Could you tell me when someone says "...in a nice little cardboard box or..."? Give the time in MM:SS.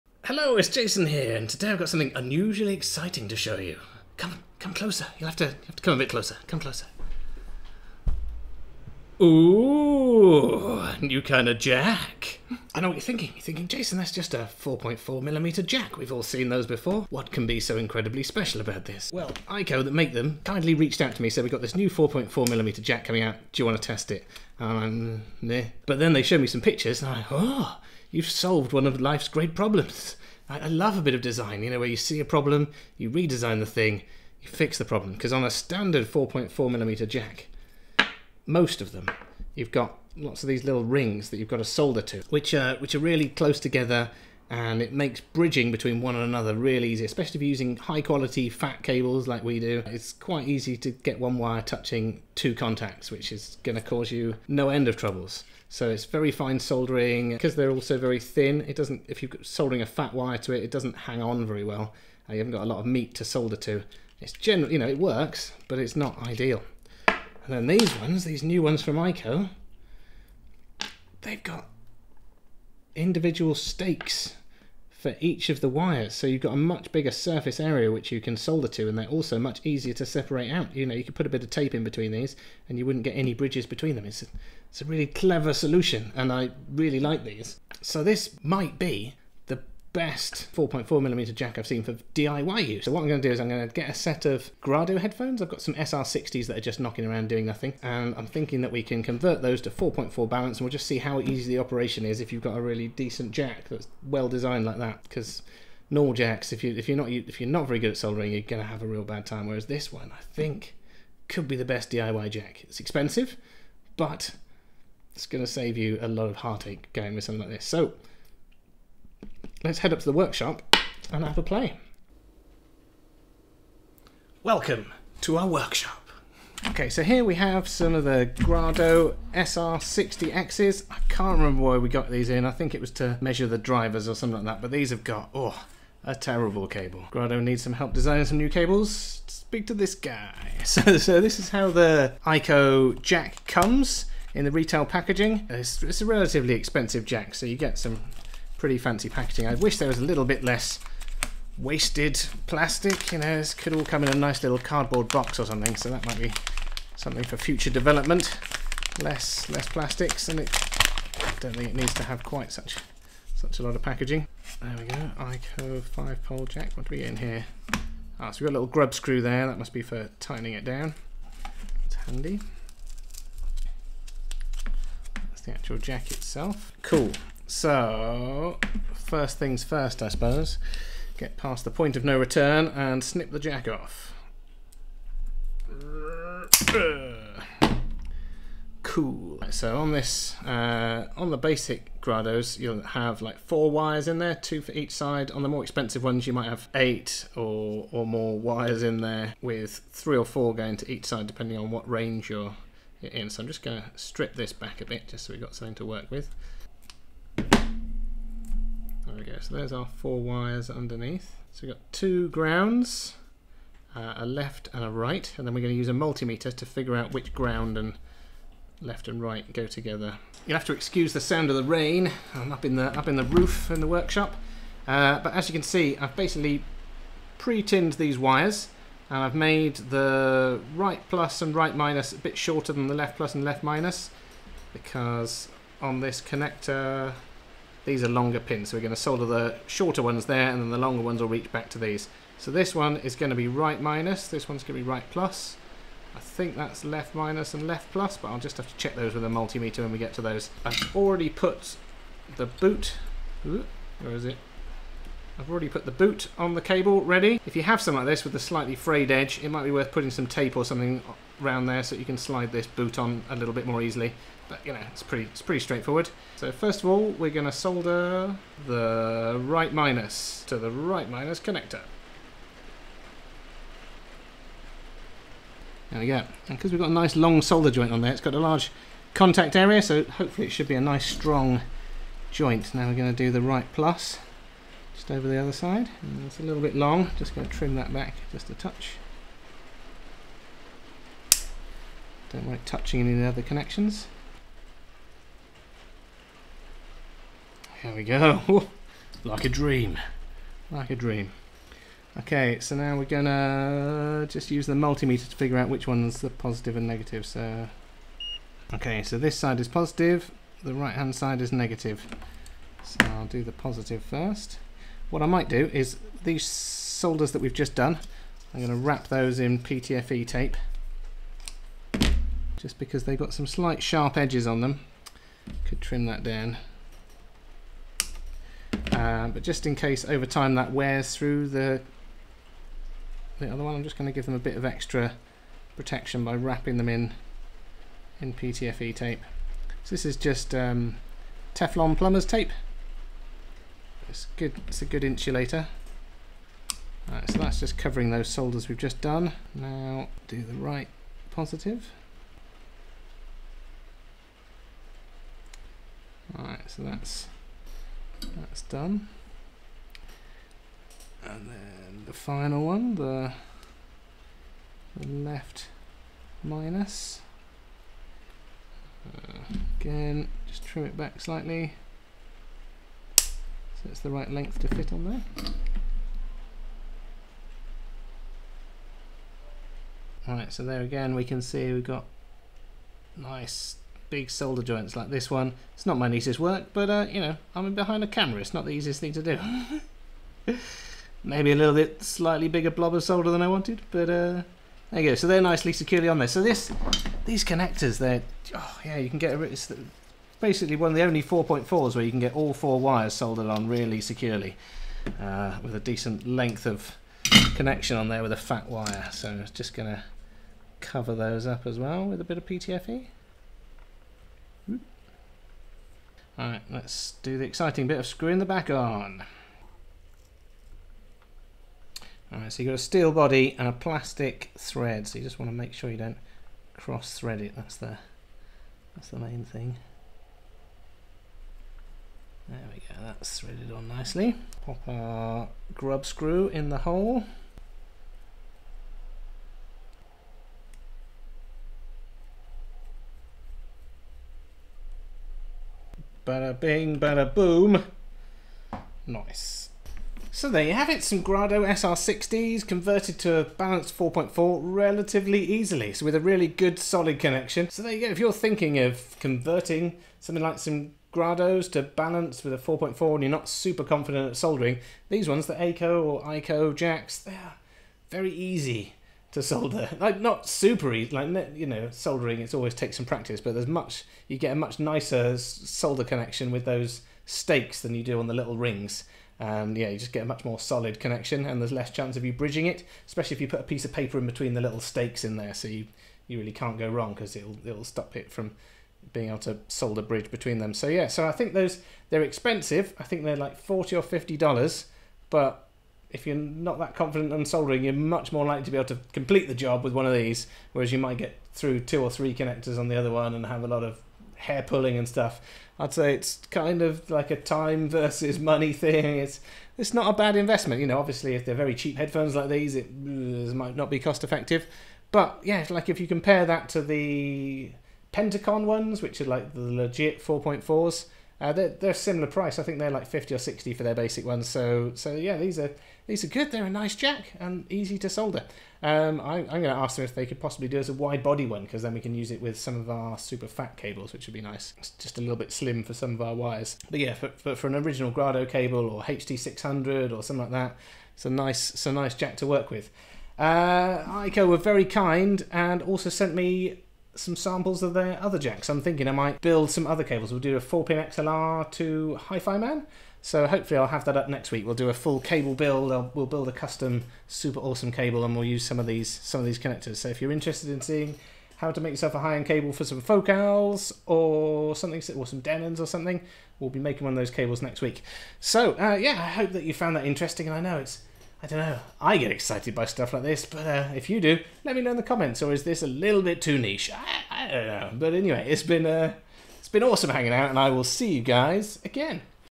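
02:34.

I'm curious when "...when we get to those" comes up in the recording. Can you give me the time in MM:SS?
04:09.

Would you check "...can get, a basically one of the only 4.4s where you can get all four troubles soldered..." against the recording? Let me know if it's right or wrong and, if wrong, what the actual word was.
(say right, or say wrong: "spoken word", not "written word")
wrong: "wires", not "troubles".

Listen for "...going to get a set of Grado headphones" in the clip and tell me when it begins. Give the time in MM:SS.
01:33.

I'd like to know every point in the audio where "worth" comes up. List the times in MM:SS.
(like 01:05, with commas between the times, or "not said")
04:19.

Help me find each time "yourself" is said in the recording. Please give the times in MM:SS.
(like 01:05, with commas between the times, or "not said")
09:21.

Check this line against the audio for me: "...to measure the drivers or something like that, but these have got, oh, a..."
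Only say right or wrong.
right.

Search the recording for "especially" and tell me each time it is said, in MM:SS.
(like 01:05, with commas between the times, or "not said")
00:47, 08:03.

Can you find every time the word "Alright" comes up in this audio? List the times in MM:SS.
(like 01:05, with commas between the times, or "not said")
05:56, 06:20, 06:56, 07:02.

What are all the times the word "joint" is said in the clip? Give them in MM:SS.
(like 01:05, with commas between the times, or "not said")
04:37, 04:42, 06:24.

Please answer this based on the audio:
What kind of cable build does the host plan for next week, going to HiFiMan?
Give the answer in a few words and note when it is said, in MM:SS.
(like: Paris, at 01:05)
4-pin XLR, at 09:10.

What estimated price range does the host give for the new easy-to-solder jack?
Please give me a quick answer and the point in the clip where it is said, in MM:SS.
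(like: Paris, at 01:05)
$40 to $50, at 08:13.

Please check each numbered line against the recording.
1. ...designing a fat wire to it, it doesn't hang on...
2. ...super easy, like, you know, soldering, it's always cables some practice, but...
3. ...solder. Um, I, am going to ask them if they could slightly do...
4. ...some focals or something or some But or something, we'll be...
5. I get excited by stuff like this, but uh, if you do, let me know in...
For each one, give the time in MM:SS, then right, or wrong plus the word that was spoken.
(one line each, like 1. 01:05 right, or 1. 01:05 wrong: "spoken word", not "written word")
1. 00:59 wrong: "soldering", not "designing"
2. 07:50 wrong: "takes", not "cables"
3. 08:48 wrong: "possibly", not "slightly"
4. 09:22 wrong: "Denons", not "But"
5. 09:31 right.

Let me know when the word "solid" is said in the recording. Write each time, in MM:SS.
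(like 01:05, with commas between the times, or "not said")
07:36, 08:00.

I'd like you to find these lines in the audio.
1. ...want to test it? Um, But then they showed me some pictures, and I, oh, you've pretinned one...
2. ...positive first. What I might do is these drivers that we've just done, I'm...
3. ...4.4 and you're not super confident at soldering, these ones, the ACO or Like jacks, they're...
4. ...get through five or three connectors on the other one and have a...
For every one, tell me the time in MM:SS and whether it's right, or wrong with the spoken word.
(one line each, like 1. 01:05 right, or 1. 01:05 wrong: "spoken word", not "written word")
1. 00:23 wrong: "solved", not "pretinned"
2. 05:13 wrong: "solders", not "drivers"
3. 07:42 wrong: "ICO", not "Like"
4. 08:21 wrong: "two", not "five".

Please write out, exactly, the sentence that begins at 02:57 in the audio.
So, first things first, I suppose.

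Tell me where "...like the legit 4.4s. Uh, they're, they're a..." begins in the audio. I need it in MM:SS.
08:39.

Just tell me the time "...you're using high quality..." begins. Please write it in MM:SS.
00:47.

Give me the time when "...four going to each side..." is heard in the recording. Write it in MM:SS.
03:20.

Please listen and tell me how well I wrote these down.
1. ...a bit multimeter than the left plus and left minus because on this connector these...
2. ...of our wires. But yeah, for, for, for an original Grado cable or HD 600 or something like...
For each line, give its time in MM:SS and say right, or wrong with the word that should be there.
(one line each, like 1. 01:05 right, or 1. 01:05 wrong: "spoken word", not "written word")
1. 03:52 wrong: "shorter", not "multimeter"
2. 08:56 right.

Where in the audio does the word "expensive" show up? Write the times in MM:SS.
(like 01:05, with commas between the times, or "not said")
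01:52, 02:26, 03:15, 08:12.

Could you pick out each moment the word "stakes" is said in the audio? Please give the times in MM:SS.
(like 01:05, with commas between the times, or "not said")
01:13, 07:57, 08:04.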